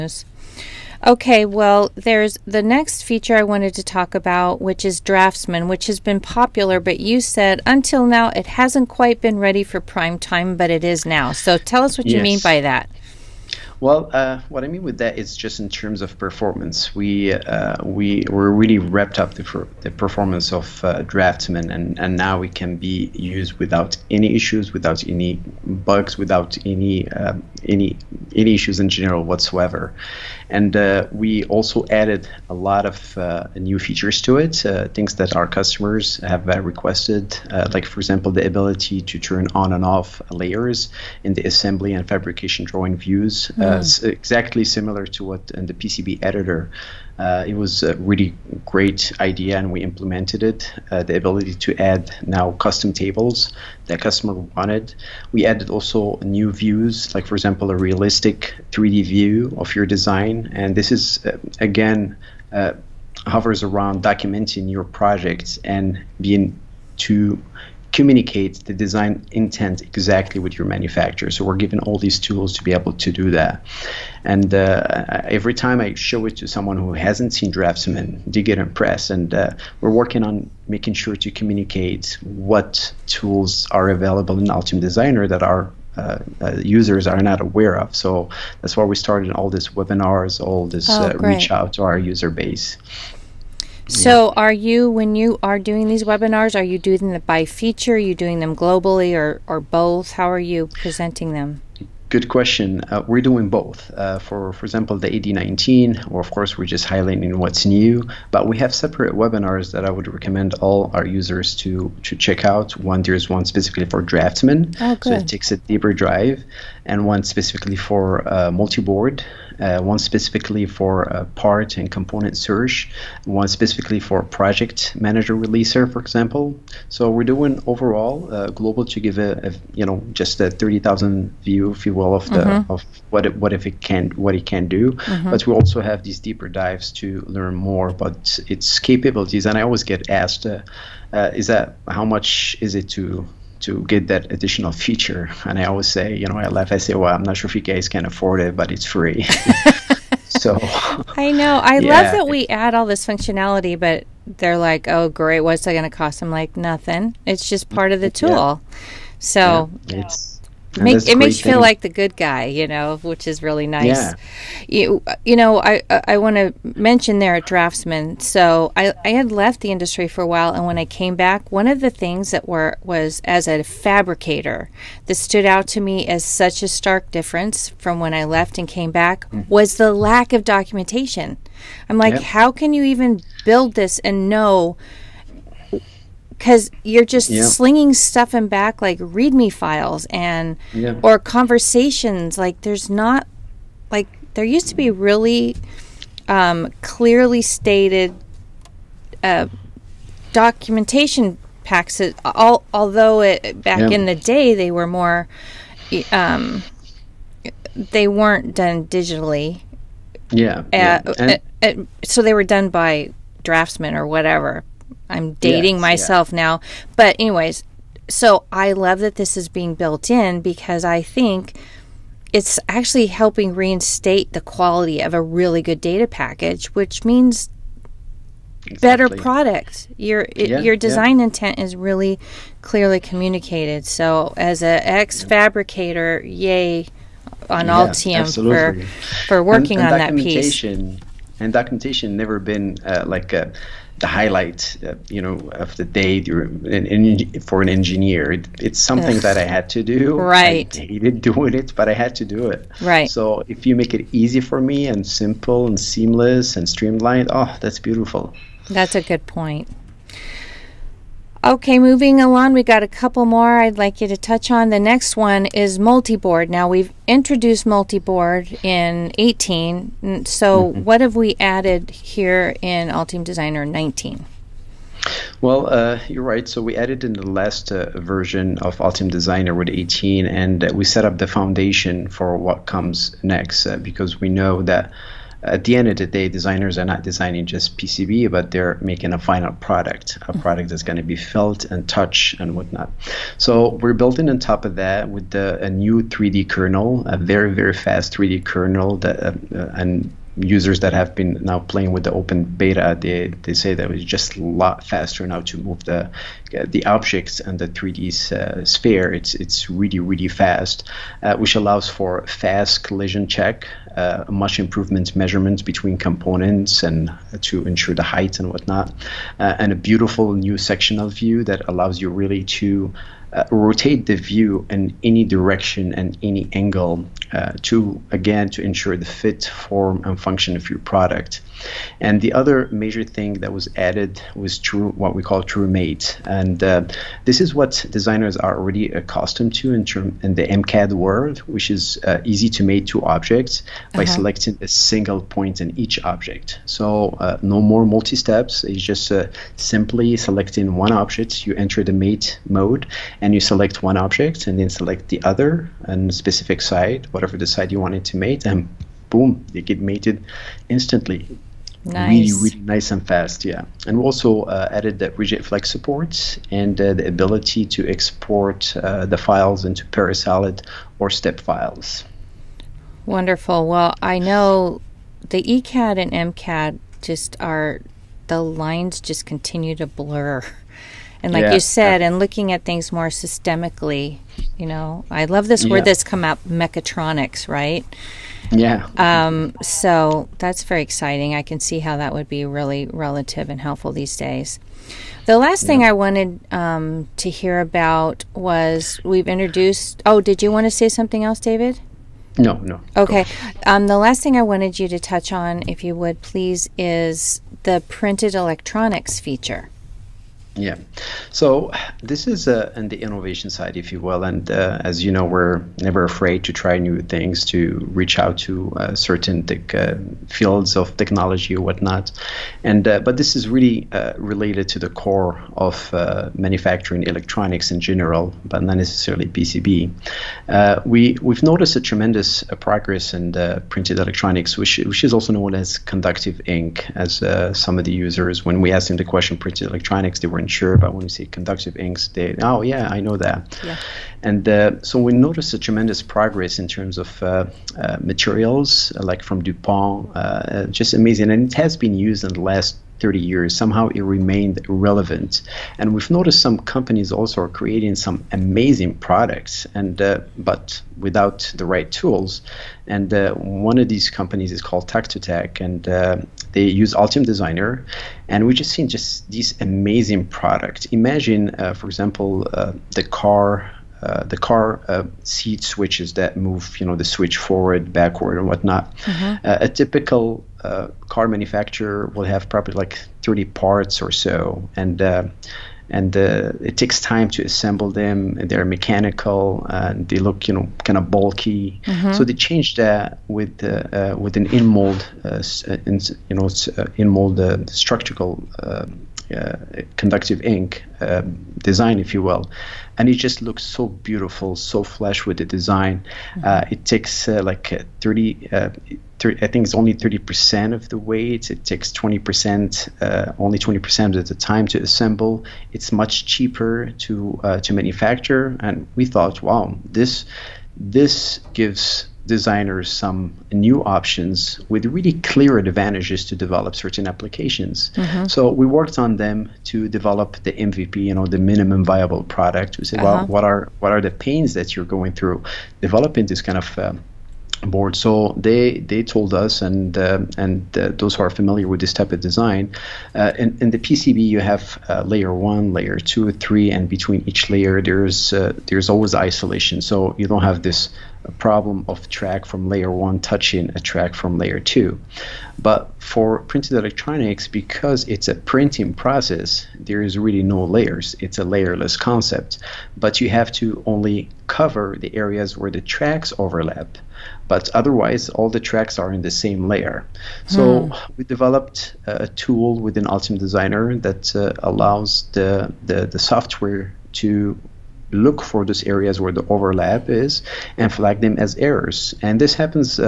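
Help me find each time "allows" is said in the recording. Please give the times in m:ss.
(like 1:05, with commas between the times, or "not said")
5:11, 5:21, 9:34.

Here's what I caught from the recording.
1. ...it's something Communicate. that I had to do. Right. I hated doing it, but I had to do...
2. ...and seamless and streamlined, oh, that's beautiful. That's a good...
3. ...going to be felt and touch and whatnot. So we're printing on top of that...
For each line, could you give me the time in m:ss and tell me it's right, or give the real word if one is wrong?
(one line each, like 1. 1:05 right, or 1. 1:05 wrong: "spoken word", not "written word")
1. 4:08 wrong: "Ugh", not "Communicate"
2. 4:15 right
3. 4:50 wrong: "building", not "printing".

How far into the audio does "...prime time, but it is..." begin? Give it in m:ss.
0:09.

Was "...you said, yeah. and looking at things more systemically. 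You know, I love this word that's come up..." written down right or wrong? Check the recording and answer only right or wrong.
right.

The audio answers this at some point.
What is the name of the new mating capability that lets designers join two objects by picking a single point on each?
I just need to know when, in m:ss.
5:35.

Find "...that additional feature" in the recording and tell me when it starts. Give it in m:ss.
2:24.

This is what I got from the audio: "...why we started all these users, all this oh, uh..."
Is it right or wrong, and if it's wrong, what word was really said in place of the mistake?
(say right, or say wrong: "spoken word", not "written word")
wrong: "webinars", not "users".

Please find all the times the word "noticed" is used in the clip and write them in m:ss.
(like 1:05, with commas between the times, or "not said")
7:11, 7:25, 7:36.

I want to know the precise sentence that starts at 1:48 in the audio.
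But we have separate webinars that I would recommend all our users to to check out.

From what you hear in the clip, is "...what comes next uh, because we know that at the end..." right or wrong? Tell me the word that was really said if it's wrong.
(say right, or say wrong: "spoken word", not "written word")
right.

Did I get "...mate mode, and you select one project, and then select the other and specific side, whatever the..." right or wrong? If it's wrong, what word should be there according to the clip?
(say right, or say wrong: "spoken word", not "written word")
wrong: "object", not "project".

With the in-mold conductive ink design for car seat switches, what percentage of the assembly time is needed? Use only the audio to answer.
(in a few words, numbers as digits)
20%.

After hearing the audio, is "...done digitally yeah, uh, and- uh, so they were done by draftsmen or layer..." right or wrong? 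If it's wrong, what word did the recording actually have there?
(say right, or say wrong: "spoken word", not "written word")
wrong: "whatever", not "layer".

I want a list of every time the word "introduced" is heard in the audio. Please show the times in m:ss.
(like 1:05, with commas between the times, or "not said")
4:27, 6:39.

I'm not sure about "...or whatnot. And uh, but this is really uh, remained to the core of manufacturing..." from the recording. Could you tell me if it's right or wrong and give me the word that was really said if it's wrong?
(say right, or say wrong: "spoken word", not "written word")
wrong: "related", not "remained".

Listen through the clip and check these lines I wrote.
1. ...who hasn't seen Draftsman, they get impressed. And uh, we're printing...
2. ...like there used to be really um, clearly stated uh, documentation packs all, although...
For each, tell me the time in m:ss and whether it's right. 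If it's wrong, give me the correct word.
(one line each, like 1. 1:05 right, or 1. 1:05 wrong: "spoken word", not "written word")
1. 1:16 wrong: "working", not "printing"
2. 3:13 right.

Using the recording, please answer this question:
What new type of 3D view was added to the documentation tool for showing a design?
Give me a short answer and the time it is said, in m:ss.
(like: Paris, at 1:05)
Realistic 3D view, at 0:57.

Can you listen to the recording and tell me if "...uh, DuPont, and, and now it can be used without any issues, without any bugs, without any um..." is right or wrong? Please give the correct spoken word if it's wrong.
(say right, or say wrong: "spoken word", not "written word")
wrong: "Draftsman", not "DuPont".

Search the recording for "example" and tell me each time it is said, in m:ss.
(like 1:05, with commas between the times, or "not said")
0:38, 0:57, 1:44, 2:05, 7:51.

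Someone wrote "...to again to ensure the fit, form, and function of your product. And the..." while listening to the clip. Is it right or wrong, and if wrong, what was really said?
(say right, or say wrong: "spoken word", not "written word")
right.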